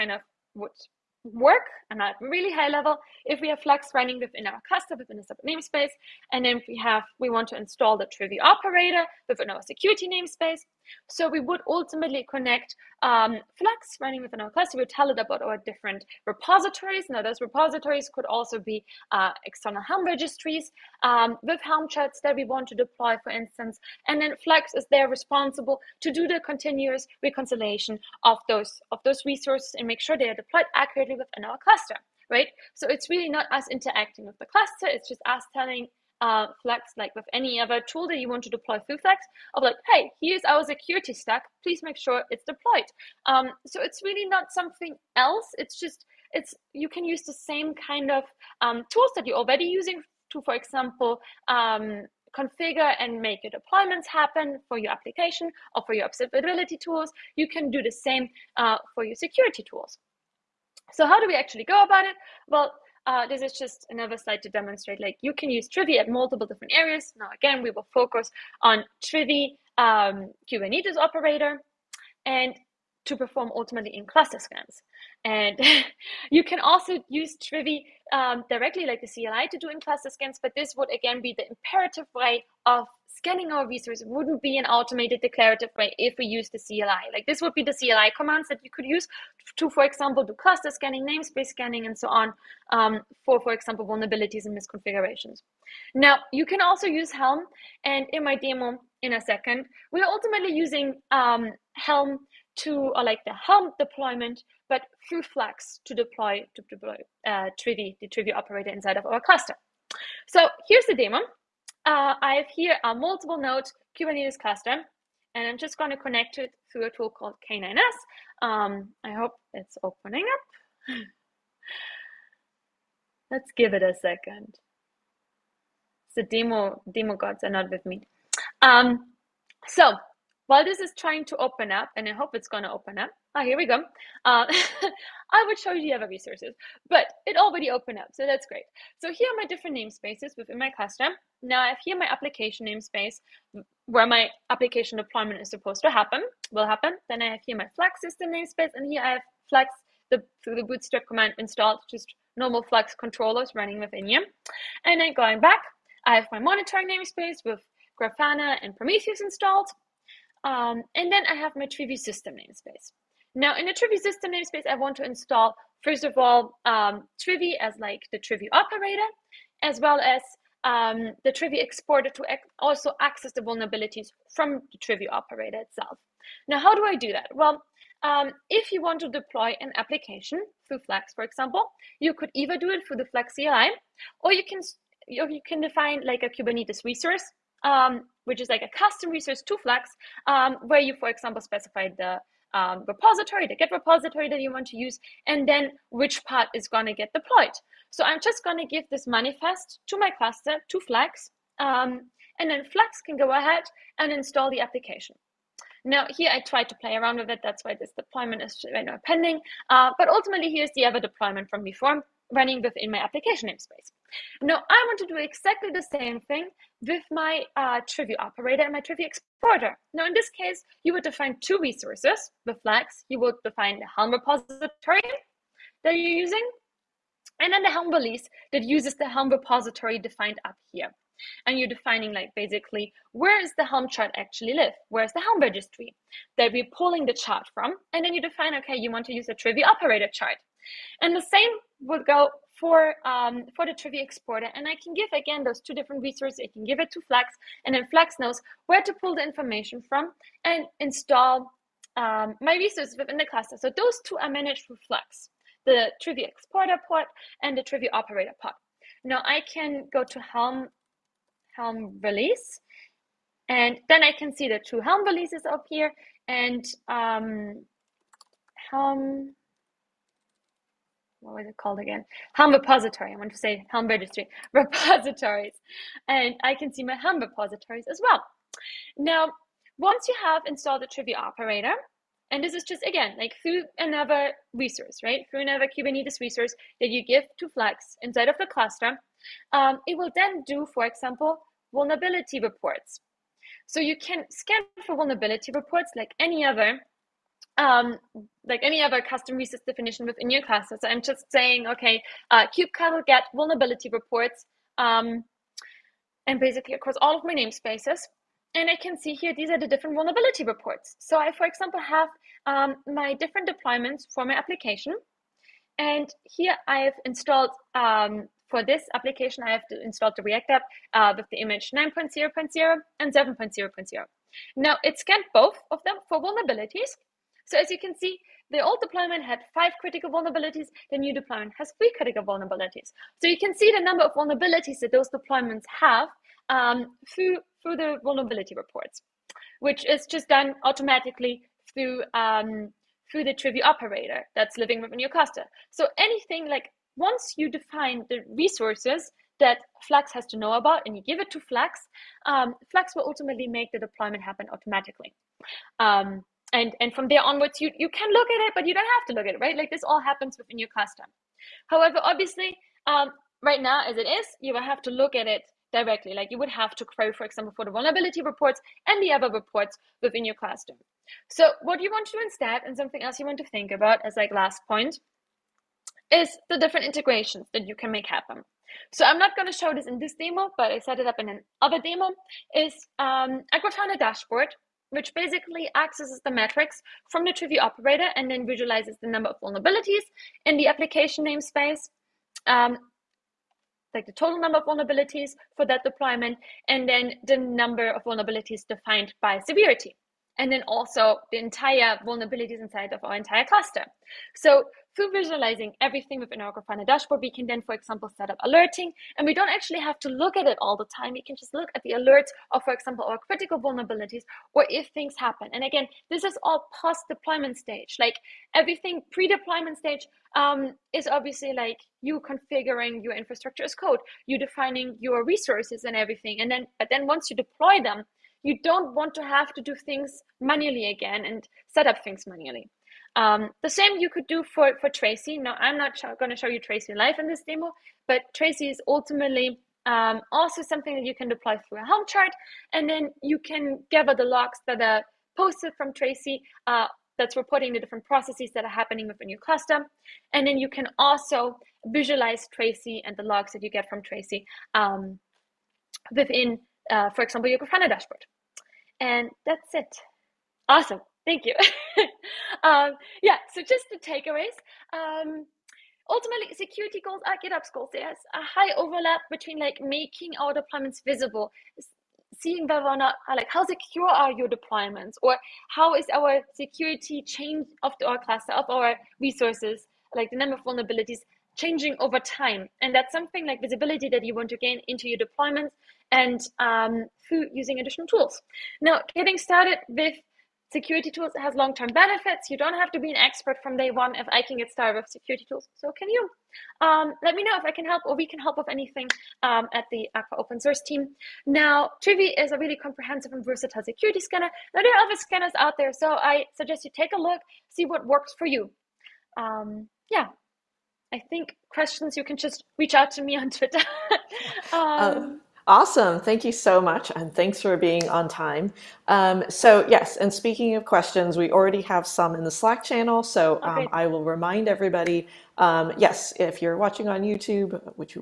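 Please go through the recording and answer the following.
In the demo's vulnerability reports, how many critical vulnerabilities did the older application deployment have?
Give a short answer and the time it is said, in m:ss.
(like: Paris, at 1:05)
5, at 5:29.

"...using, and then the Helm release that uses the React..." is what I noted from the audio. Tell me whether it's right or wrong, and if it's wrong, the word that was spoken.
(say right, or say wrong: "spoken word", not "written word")
wrong: "Helm", not "React".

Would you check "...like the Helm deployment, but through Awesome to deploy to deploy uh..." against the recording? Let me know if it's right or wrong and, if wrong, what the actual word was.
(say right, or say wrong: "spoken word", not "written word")
wrong: "Flux", not "Awesome".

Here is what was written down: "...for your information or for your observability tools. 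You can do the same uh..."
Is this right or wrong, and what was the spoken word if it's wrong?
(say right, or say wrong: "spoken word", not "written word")
wrong: "application", not "information".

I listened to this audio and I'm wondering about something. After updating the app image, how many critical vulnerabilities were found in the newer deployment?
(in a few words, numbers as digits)
3.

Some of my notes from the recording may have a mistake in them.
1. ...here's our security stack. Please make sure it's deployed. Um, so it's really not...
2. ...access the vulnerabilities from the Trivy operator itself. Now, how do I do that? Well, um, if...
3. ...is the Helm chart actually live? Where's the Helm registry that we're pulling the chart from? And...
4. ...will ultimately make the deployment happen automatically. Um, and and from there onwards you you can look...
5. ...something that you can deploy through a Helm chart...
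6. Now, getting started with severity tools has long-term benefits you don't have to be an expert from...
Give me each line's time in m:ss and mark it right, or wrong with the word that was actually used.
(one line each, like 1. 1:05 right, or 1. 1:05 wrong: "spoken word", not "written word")
1. 0:40 right
2. 2:53 right
3. 3:53 right
4. 5:52 right
5. 7:20 right
6. 8:08 wrong: "security", not "severity".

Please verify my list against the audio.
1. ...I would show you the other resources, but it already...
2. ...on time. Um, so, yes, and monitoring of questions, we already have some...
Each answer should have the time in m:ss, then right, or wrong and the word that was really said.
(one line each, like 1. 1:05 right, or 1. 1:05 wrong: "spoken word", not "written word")
1. 2:15 right
2. 8:38 wrong: "speaking", not "monitoring".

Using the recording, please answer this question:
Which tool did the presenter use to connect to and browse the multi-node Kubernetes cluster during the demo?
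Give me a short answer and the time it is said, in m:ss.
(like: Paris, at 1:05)
K9s, at 1:57.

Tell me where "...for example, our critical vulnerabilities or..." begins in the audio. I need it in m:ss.
6:52.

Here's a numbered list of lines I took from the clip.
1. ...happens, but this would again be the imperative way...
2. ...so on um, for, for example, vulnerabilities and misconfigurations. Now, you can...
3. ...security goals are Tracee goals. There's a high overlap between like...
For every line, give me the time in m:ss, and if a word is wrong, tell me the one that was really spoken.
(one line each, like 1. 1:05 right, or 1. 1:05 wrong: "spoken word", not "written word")
1. 1:20 wrong: "scans", not "happens"
2. 1:31 right
3. 7:46 wrong: "GitOps", not "Tracee".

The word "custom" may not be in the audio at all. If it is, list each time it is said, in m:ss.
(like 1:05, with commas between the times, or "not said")
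3:08, 4:59, 6:00, 6:10.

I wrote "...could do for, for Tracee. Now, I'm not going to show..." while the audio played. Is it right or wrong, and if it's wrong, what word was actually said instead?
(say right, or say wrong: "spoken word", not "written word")
right.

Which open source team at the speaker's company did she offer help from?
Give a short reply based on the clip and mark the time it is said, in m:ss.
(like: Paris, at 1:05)
Aqua open source team, at 8:20.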